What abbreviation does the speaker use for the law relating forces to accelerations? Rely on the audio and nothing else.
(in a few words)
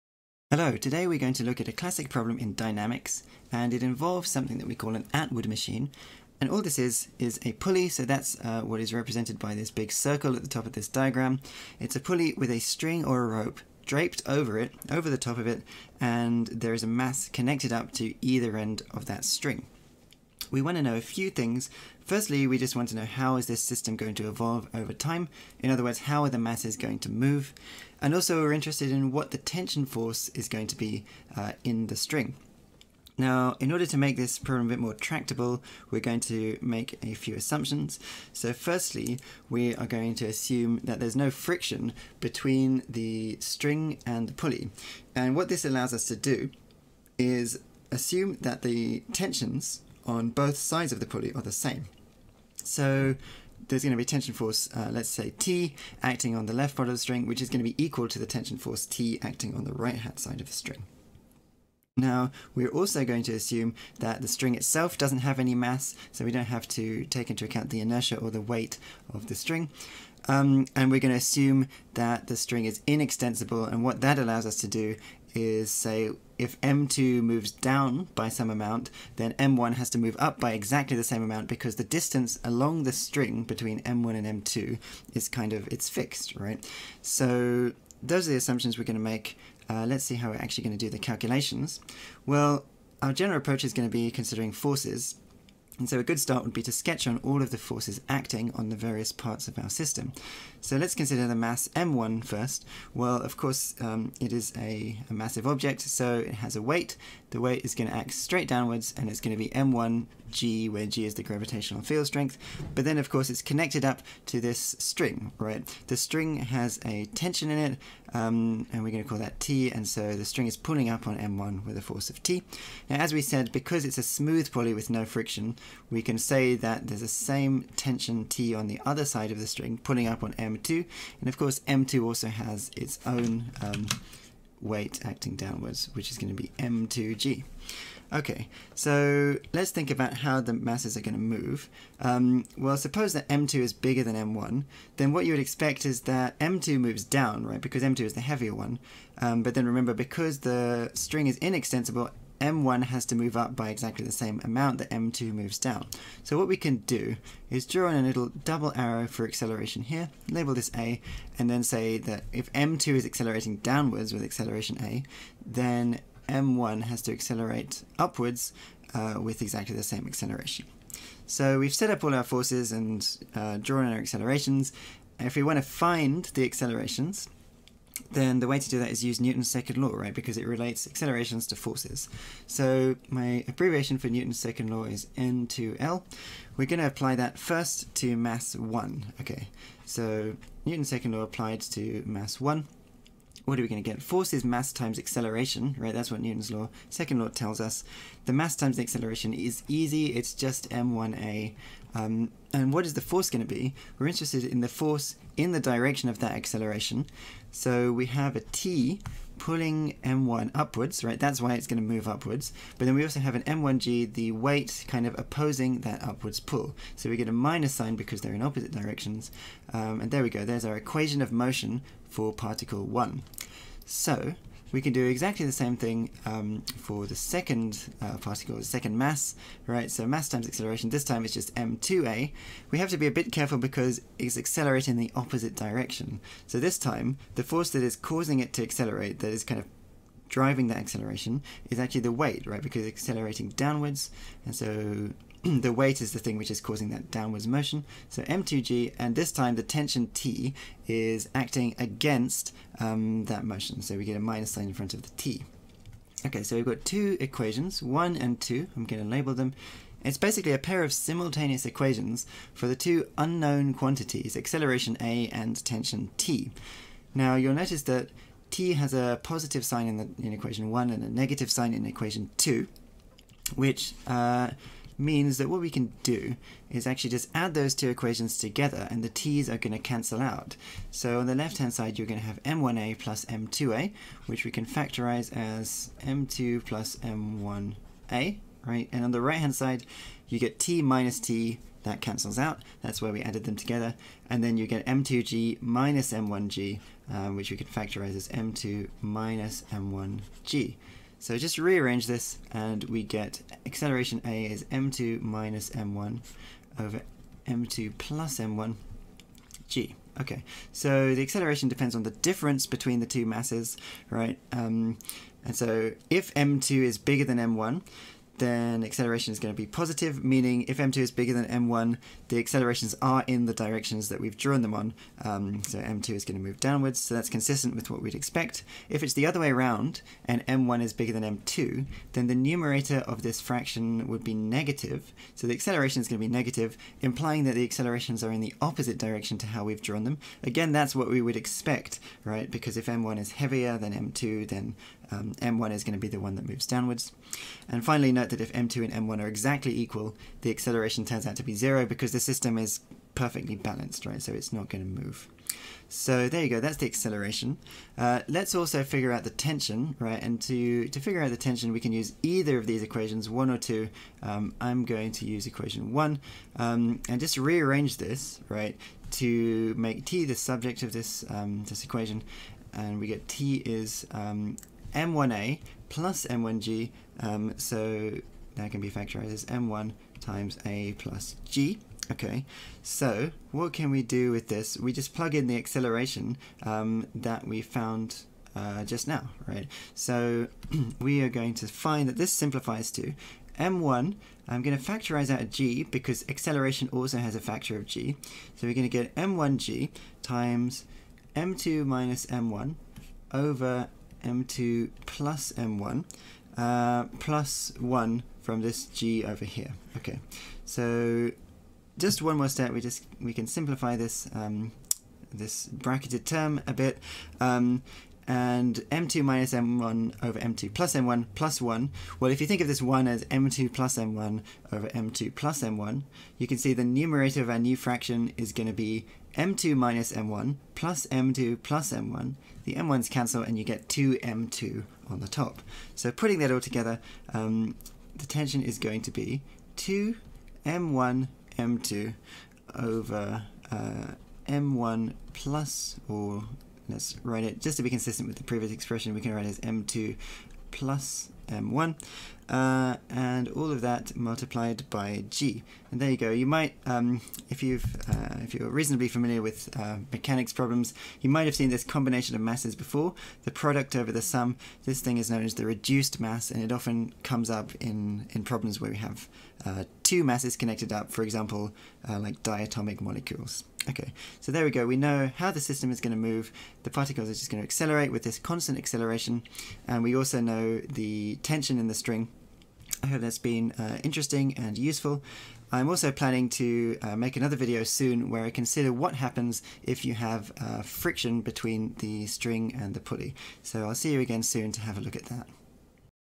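N to L.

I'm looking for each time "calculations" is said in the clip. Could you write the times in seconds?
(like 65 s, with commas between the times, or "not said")
90 s.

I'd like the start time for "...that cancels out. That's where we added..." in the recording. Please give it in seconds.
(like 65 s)
291 s.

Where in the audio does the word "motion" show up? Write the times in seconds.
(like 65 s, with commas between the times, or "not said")
221 s, 247 s, 253 s.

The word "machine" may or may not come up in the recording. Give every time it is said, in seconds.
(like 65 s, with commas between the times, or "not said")
5 s.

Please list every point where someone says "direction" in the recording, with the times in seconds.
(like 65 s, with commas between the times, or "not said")
205 s, 218 s, 235 s, 323 s, 338 s.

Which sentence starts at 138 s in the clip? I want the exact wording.
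Okay, so let's think about how the masses are going to move.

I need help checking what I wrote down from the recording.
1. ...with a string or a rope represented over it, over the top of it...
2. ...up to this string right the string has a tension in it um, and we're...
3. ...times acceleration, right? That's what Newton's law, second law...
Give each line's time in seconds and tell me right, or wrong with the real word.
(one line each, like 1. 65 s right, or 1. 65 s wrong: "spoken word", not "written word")
1. 12 s wrong: "draped", not "represented"
2. 113 s right
3. 194 s right.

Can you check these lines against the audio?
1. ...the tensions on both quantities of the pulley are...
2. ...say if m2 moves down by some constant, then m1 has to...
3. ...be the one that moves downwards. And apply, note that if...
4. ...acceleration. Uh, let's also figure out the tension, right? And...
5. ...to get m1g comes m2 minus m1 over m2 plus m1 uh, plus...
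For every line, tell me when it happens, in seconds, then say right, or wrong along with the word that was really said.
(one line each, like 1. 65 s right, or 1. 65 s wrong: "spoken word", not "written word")
1. 48 s wrong: "sides", not "quantities"
2. 75 s wrong: "amount", not "constant"
3. 345 s wrong: "finally", not "apply"
4. 356 s right
5. 398 s wrong: "times", not "comes".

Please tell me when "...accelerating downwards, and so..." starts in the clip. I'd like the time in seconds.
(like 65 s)
243 s.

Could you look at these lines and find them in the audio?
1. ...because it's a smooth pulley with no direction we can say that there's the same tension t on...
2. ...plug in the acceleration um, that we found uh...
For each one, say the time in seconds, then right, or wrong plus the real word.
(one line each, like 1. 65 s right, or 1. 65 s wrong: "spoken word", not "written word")
1. 123 s wrong: "friction", not "direction"
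2. 385 s right.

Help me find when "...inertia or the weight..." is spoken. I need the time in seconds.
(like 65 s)
67 s.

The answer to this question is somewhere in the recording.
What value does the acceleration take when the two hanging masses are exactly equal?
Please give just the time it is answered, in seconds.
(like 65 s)
351 s.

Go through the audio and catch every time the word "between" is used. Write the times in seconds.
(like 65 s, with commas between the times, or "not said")
42 s, 83 s, 312 s, 491 s.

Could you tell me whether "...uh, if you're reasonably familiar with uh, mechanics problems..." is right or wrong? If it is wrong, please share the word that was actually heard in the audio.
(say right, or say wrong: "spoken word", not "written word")
right.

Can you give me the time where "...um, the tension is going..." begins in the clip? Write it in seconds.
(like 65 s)
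437 s.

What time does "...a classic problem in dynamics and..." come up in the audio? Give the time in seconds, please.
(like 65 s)
1 s.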